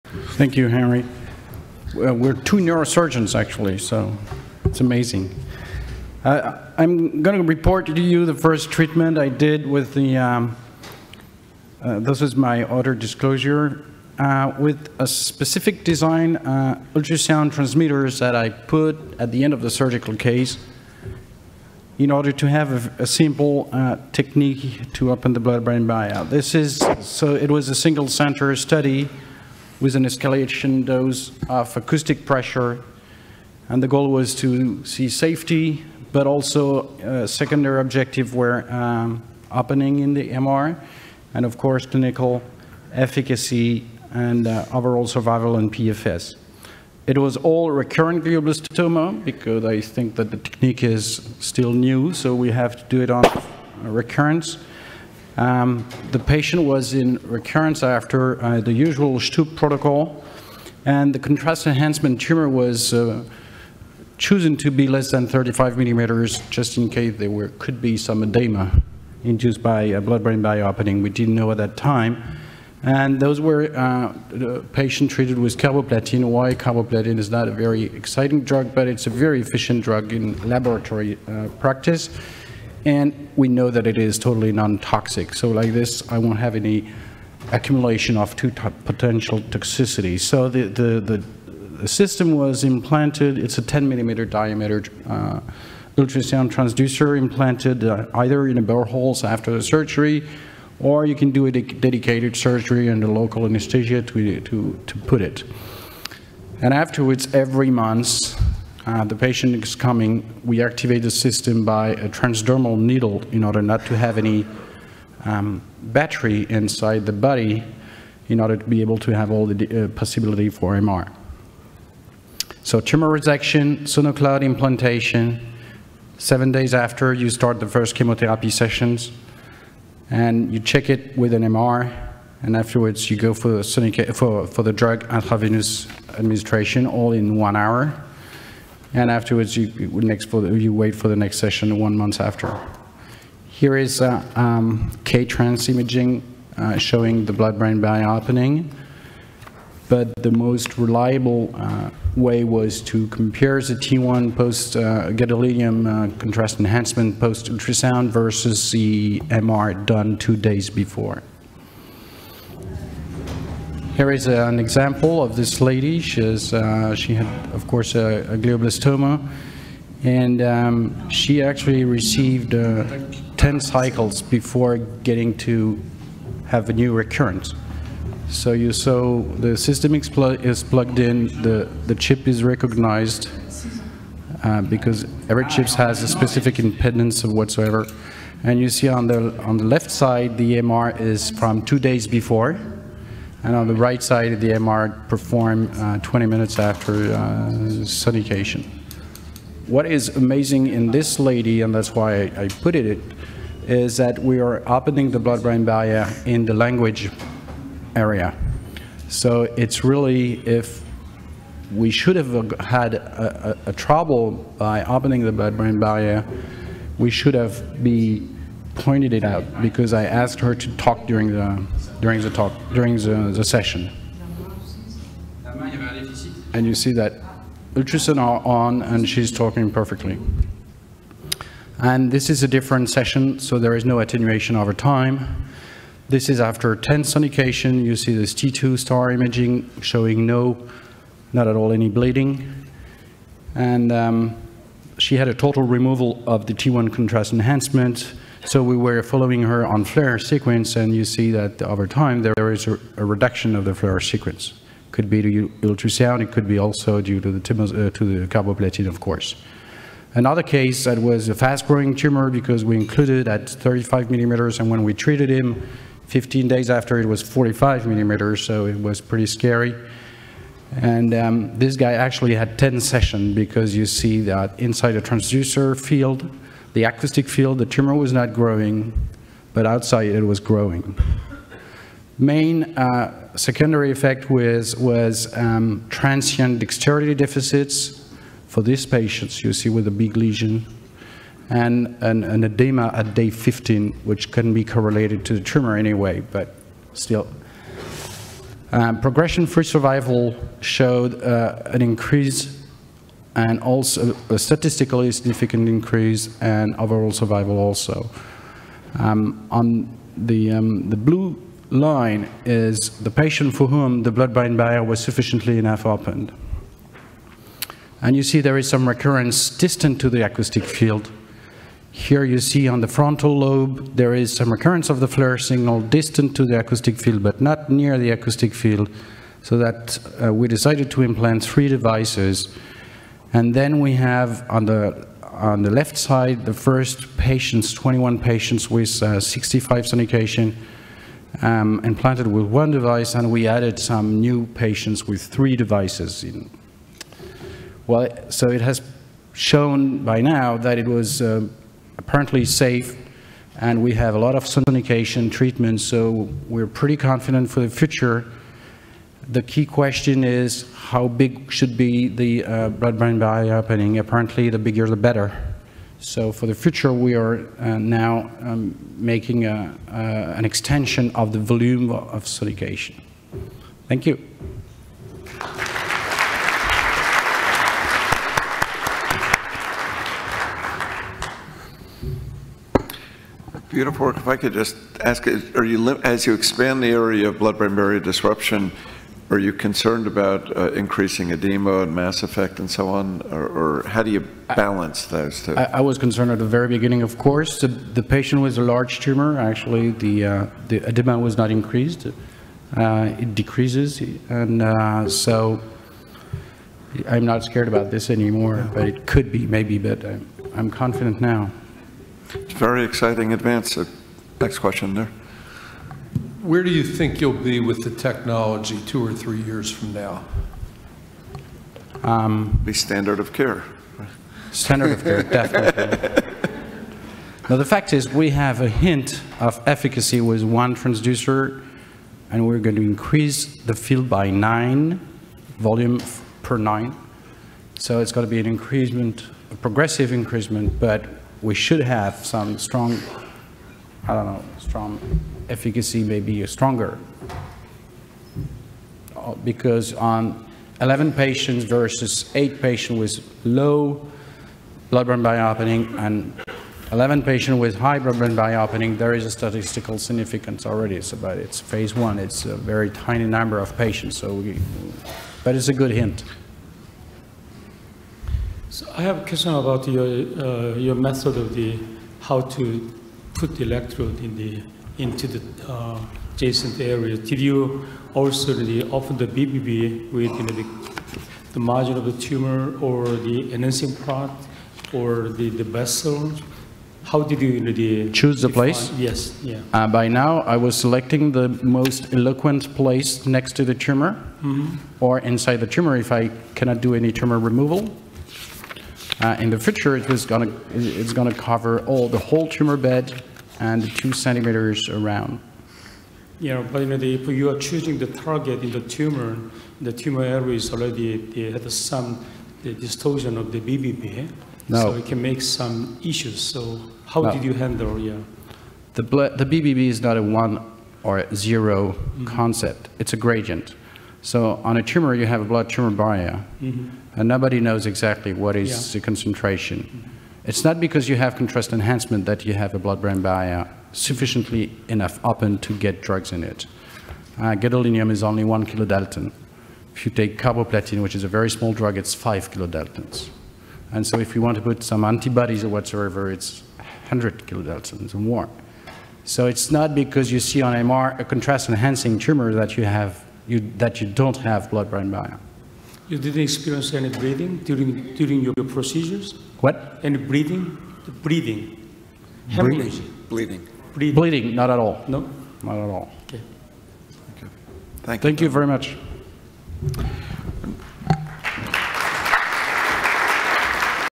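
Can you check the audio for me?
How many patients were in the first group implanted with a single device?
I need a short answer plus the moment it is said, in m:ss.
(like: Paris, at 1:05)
21, at 5:37.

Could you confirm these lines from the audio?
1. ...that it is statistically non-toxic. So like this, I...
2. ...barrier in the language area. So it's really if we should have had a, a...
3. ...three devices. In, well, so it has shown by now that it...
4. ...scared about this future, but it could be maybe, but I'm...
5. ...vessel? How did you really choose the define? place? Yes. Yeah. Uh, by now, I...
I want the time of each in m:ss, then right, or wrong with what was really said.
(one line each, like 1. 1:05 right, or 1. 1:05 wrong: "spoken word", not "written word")
1. 1:23 wrong: "totally", not "statistically"
2. 3:25 right
3. 5:45 right
4. 6:47 wrong: "anymore", not "future"
5. 8:05 right.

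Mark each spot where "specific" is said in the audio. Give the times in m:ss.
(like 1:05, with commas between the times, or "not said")
0:15, 3:06.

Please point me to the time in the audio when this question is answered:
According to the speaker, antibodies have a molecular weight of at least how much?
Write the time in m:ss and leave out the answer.
9:06.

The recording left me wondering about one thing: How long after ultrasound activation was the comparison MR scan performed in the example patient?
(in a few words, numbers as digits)
20 minutes.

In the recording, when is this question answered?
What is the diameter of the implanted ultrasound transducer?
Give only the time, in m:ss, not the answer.
1:33.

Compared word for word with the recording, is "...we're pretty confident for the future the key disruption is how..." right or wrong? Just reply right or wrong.
wrong.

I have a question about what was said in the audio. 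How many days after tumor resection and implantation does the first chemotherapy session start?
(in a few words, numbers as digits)
7.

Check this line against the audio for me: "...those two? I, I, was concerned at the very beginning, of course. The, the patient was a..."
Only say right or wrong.
right.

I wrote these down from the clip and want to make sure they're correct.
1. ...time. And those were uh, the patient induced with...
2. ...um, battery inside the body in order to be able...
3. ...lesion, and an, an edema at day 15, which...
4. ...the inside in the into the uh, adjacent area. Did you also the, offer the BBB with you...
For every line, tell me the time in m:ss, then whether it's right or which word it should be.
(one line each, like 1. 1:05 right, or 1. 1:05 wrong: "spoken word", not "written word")
1. 1:11 wrong: "treated", not "induced"
2. 1:55 right
3. 4:50 right
4. 7:53 wrong: "electrode", not "inside".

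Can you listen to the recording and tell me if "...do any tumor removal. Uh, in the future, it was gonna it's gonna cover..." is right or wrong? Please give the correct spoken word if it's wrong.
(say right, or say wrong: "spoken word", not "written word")
right.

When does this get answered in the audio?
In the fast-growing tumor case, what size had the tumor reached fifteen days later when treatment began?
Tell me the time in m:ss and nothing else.
4:27.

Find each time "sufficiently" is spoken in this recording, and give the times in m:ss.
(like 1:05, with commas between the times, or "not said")
5:15, 8:53.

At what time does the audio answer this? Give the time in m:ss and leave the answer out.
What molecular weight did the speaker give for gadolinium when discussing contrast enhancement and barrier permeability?
8:58.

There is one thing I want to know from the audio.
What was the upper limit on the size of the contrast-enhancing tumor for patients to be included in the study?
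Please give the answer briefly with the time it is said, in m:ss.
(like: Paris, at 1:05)
35 millimeters, at 1:04.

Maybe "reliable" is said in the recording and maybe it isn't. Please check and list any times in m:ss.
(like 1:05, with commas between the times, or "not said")
2:30.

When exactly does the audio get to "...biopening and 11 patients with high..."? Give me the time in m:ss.
7:35.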